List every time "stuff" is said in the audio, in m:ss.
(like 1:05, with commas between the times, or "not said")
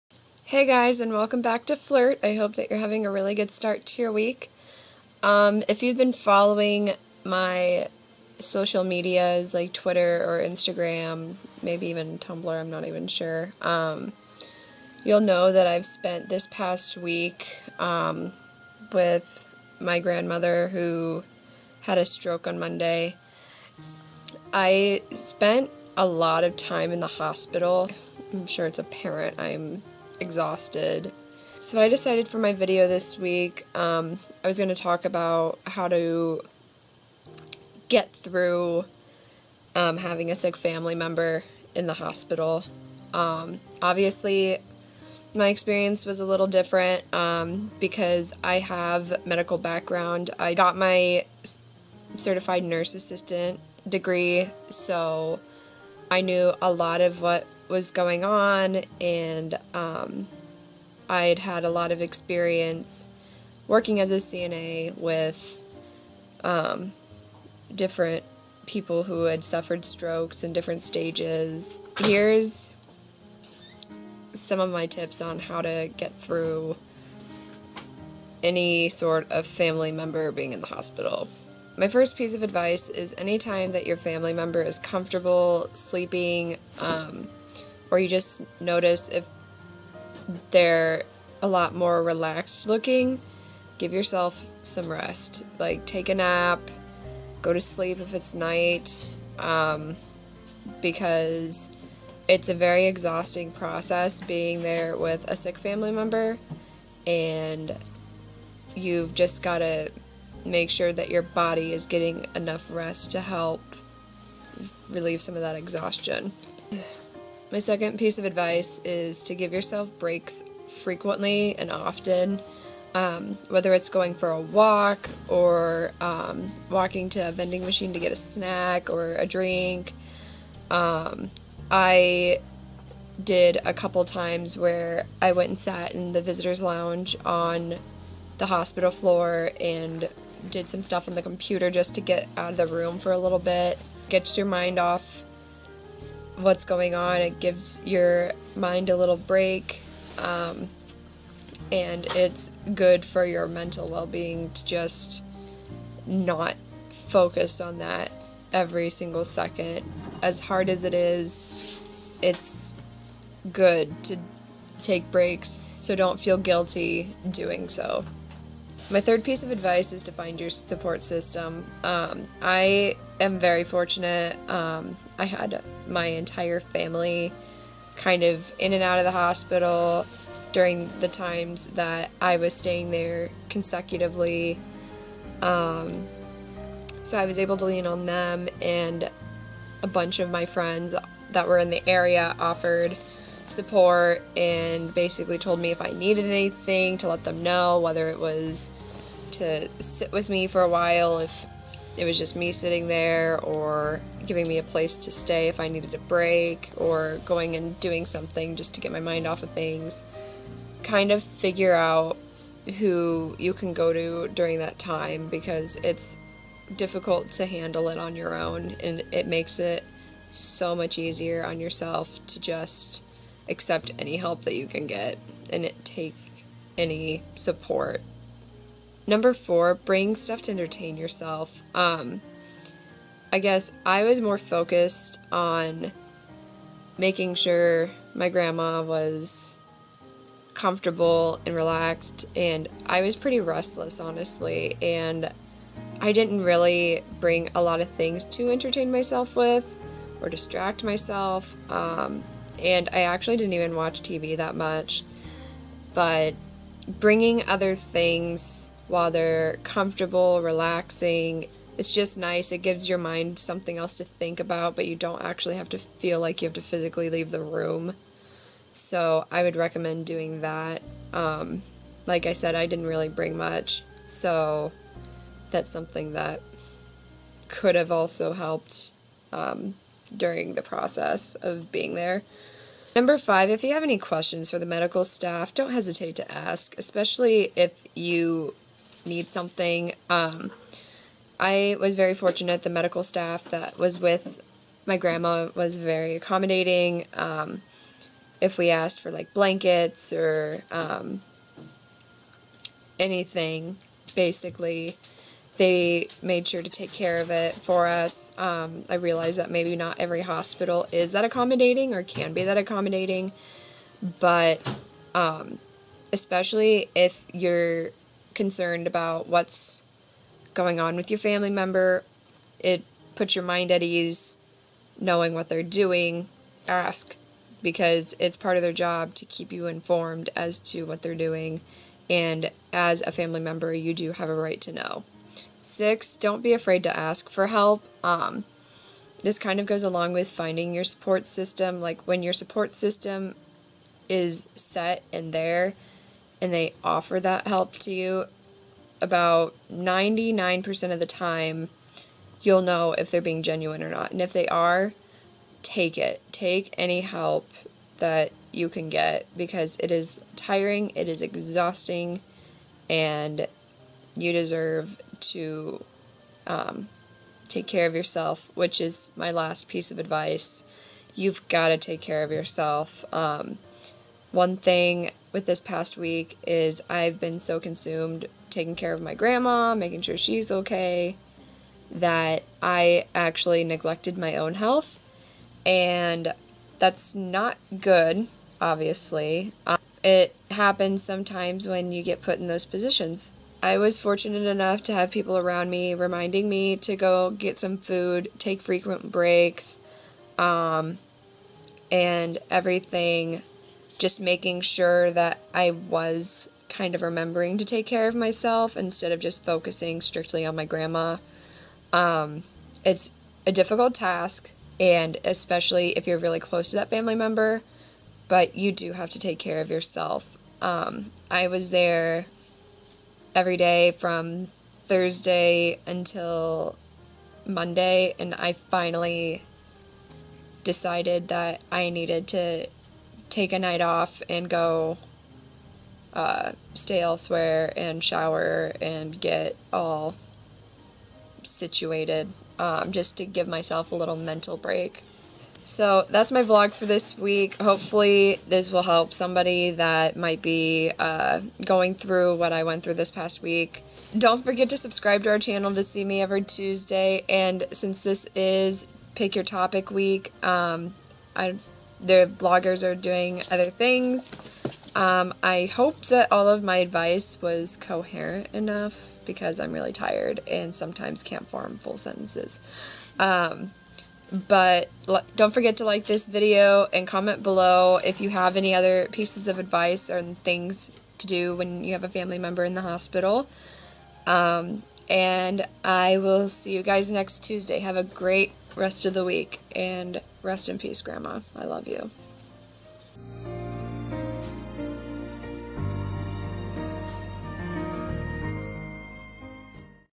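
2:20, 3:50.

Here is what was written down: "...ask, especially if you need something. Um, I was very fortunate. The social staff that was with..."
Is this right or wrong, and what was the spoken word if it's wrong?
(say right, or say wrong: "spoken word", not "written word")
wrong: "medical", not "social".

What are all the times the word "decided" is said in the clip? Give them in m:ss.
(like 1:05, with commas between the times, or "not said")
0:31, 7:10.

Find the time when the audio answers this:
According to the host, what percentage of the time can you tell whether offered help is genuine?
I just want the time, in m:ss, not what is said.
5:49.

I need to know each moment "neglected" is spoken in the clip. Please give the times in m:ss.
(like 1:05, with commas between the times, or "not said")
6:23.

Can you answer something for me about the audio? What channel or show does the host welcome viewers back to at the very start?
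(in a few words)
Flurt.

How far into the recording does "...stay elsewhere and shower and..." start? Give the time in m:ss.
7:16.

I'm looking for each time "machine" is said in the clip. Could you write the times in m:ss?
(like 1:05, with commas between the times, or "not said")
2:07.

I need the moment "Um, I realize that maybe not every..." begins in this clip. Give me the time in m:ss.
5:08.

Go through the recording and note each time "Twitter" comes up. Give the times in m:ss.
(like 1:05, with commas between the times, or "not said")
0:09.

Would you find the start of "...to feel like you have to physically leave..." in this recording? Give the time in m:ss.
4:25.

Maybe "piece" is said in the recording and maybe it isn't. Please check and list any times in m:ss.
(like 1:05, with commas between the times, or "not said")
1:22, 1:57, 2:49, 6:09, 7:59.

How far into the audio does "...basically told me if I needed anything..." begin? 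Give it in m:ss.
3:14.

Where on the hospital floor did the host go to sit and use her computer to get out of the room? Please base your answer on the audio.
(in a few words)
Visitor's lounge.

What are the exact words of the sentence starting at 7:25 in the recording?
So that's my vlog for this week.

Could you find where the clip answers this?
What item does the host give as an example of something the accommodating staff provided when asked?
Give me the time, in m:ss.
4:59.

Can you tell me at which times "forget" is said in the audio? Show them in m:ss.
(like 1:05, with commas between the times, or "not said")
7:34, 7:55.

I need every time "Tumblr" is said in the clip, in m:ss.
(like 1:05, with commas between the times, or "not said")
0:12.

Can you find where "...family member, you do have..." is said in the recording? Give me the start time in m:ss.
5:33.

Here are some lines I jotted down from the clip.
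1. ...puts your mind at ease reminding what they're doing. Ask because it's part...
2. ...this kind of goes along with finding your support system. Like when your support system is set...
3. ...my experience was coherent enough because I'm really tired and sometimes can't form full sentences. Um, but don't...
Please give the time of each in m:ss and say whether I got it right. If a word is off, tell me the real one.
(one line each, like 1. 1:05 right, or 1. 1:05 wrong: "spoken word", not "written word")
1. 5:23 wrong: "knowing", not "reminding"
2. 5:39 right
3. 7:46 wrong: "advice", not "experience".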